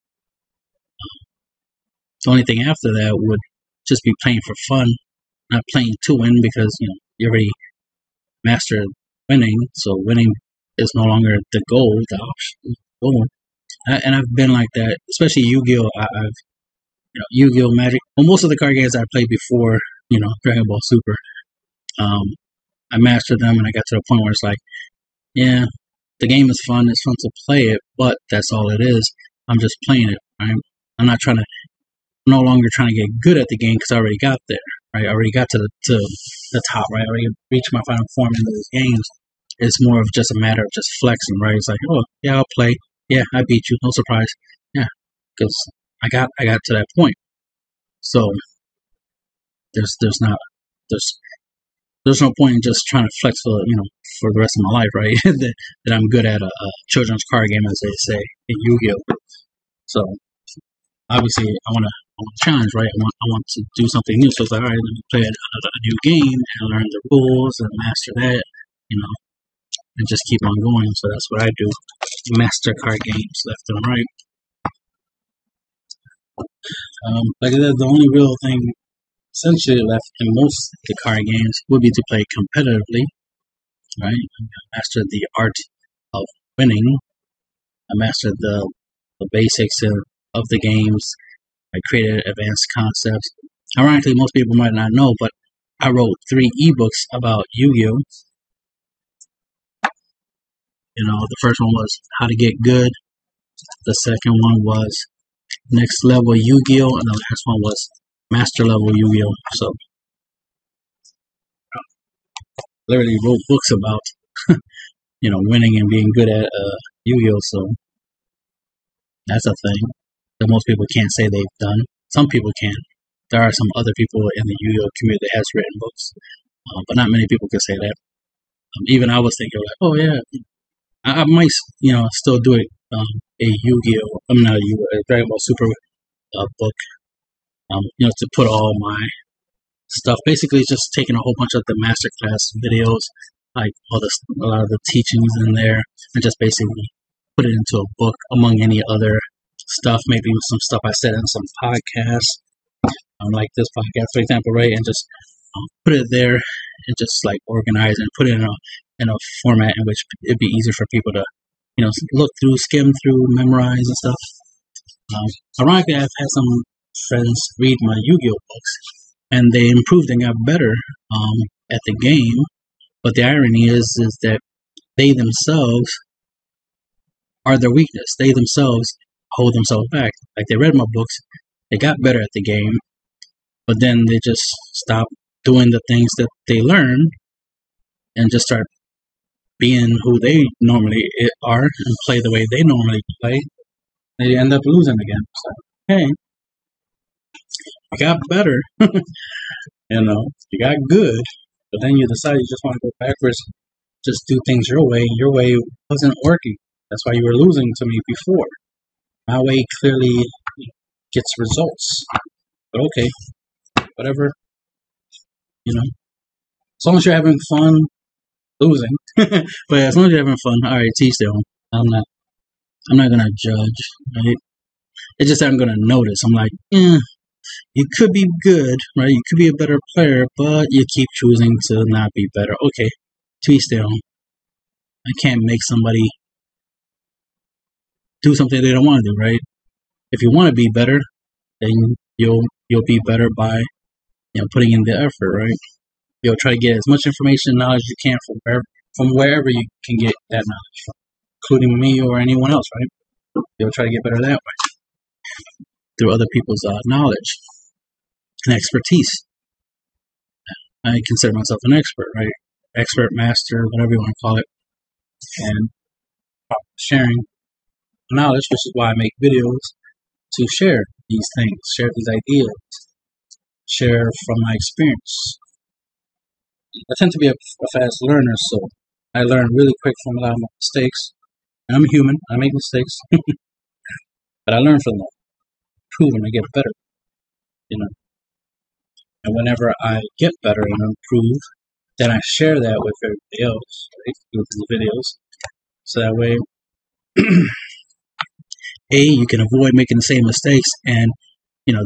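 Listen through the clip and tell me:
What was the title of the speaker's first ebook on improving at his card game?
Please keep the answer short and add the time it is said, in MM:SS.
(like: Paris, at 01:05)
How to Get Good, at 01:42.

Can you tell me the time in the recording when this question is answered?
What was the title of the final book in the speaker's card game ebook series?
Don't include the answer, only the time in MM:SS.
01:48.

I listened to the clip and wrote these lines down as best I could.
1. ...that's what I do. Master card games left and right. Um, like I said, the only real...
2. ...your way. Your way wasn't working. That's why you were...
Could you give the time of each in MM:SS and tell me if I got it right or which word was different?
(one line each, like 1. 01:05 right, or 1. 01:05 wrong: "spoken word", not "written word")
1. 01:11 right
2. 03:24 right.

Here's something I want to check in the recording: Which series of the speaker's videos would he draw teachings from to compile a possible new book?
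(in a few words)
masterclass videos.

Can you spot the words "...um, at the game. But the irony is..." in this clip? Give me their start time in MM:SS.
02:51.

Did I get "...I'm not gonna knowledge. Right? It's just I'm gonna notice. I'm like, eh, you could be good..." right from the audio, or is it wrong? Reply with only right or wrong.
wrong.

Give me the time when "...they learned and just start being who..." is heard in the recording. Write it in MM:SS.
03:06.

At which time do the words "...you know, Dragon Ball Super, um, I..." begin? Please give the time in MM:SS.
00:20.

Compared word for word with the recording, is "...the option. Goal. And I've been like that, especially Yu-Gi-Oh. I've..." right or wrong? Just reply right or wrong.
right.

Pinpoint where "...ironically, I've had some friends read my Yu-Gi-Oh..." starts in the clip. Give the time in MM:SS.
02:45.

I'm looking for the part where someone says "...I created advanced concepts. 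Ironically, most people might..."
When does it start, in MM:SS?
01:31.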